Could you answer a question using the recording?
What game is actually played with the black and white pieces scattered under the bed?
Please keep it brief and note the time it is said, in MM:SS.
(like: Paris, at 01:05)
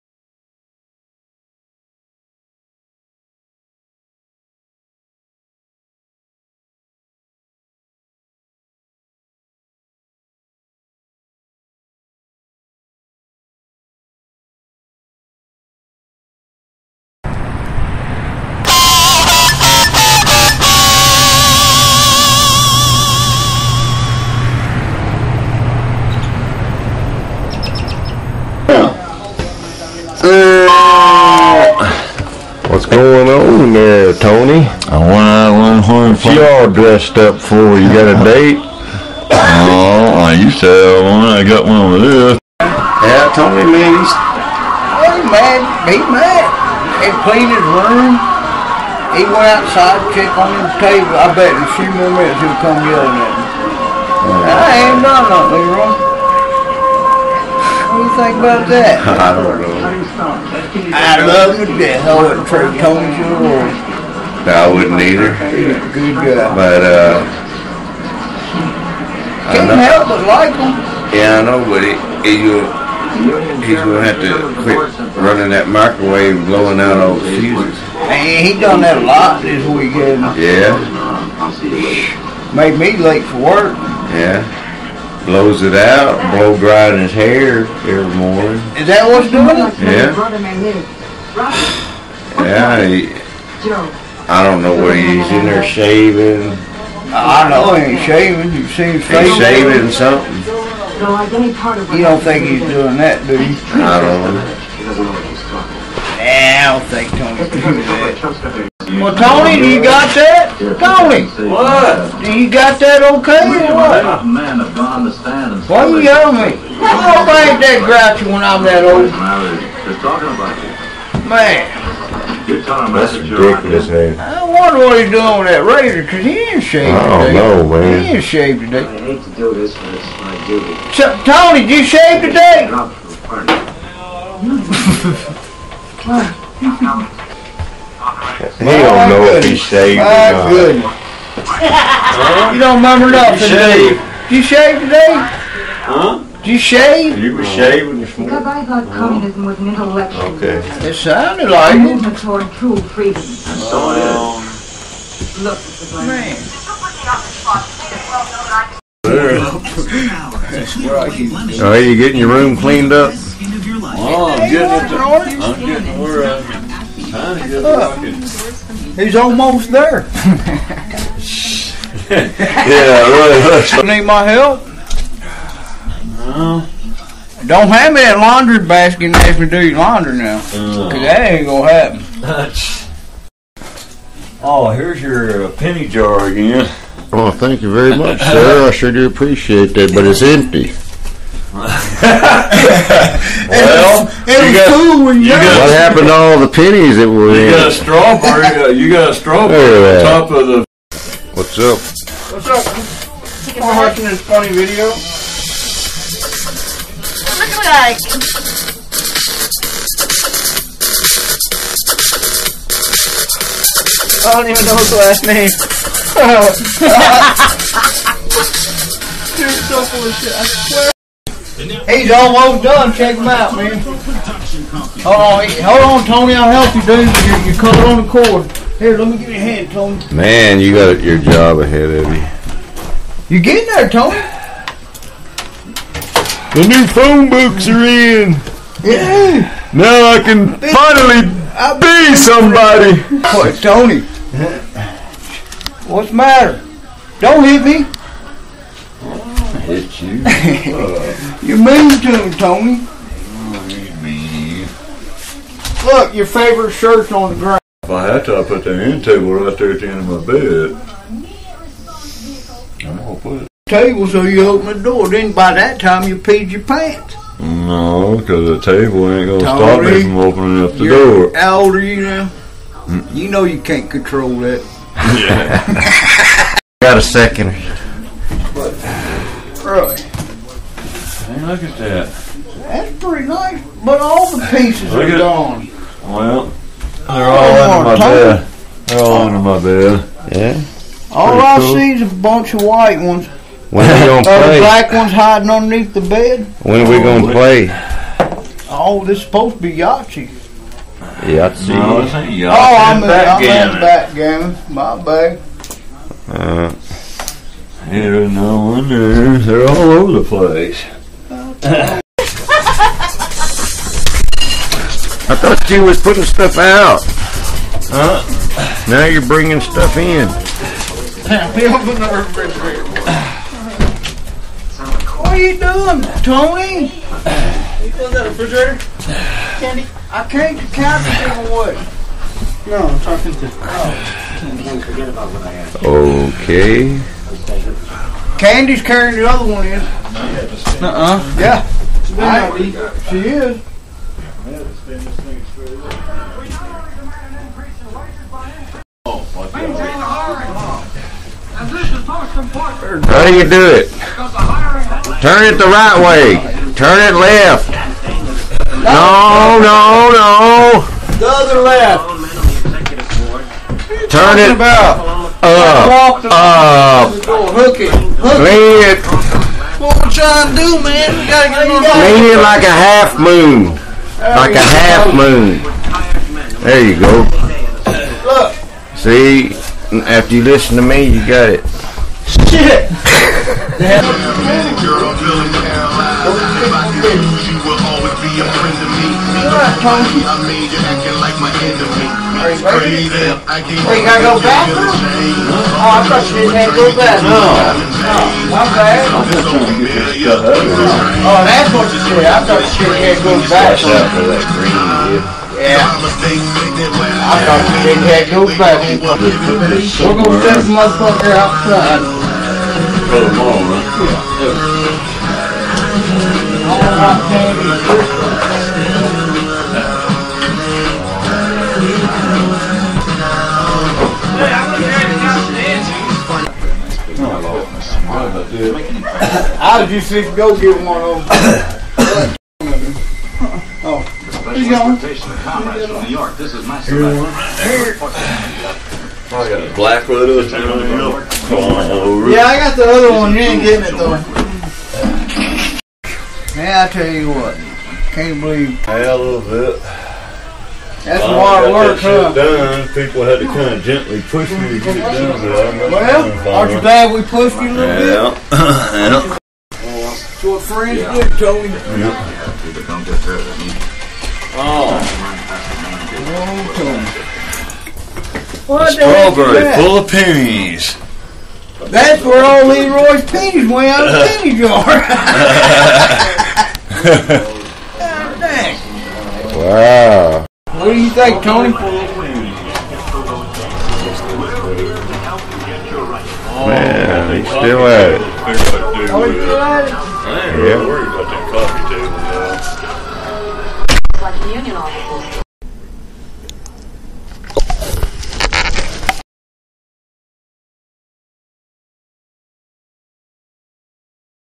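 backgammon, at 05:03.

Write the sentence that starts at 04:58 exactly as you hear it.
Oh, this is supposed to be Yahtzee.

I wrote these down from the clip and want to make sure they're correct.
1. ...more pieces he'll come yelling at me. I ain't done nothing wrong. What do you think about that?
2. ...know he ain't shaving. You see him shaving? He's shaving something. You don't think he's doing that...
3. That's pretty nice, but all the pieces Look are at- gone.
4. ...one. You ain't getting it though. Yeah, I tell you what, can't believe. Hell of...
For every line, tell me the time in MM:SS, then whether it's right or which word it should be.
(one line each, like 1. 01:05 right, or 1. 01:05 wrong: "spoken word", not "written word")
1. 00:51 wrong: "minutes", not "pieces"
2. 01:37 right
3. 04:42 right
4. 07:23 right.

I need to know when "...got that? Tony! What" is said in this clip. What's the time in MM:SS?
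01:49.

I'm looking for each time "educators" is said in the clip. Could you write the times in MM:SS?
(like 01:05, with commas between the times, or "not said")
not said.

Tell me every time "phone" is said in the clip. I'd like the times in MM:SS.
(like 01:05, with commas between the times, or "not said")
03:56.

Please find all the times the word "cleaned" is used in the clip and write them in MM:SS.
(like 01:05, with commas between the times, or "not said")
00:47, 02:42.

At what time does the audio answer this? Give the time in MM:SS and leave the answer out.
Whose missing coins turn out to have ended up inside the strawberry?
07:52.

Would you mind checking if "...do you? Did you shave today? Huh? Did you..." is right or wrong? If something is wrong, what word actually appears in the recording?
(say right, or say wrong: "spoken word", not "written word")
right.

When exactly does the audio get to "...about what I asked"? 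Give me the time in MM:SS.
05:35.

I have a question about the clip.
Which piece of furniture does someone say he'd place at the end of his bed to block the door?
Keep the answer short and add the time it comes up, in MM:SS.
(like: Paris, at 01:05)
end table, at 04:18.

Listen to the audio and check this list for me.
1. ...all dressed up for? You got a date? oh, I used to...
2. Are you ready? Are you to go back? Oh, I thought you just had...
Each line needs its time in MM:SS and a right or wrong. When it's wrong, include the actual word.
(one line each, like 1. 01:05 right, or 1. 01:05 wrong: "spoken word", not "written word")
1. 00:36 right
2. 06:32 right.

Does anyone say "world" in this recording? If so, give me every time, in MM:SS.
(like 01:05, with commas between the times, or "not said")
01:03.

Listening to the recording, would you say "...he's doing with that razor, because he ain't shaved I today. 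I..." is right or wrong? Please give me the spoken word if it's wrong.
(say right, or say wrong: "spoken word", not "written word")
right.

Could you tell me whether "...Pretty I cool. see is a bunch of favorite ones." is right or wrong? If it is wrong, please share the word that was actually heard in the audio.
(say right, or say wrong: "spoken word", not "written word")
wrong: "white", not "favorite".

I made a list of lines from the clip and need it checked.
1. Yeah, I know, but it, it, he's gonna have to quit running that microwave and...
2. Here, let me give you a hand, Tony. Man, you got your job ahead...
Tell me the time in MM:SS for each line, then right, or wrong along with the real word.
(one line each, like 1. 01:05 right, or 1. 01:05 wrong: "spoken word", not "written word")
1. 01:11 right
2. 03:48 right.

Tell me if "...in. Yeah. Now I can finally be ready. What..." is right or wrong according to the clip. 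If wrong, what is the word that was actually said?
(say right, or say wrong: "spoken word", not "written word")
wrong: "somebody", not "ready".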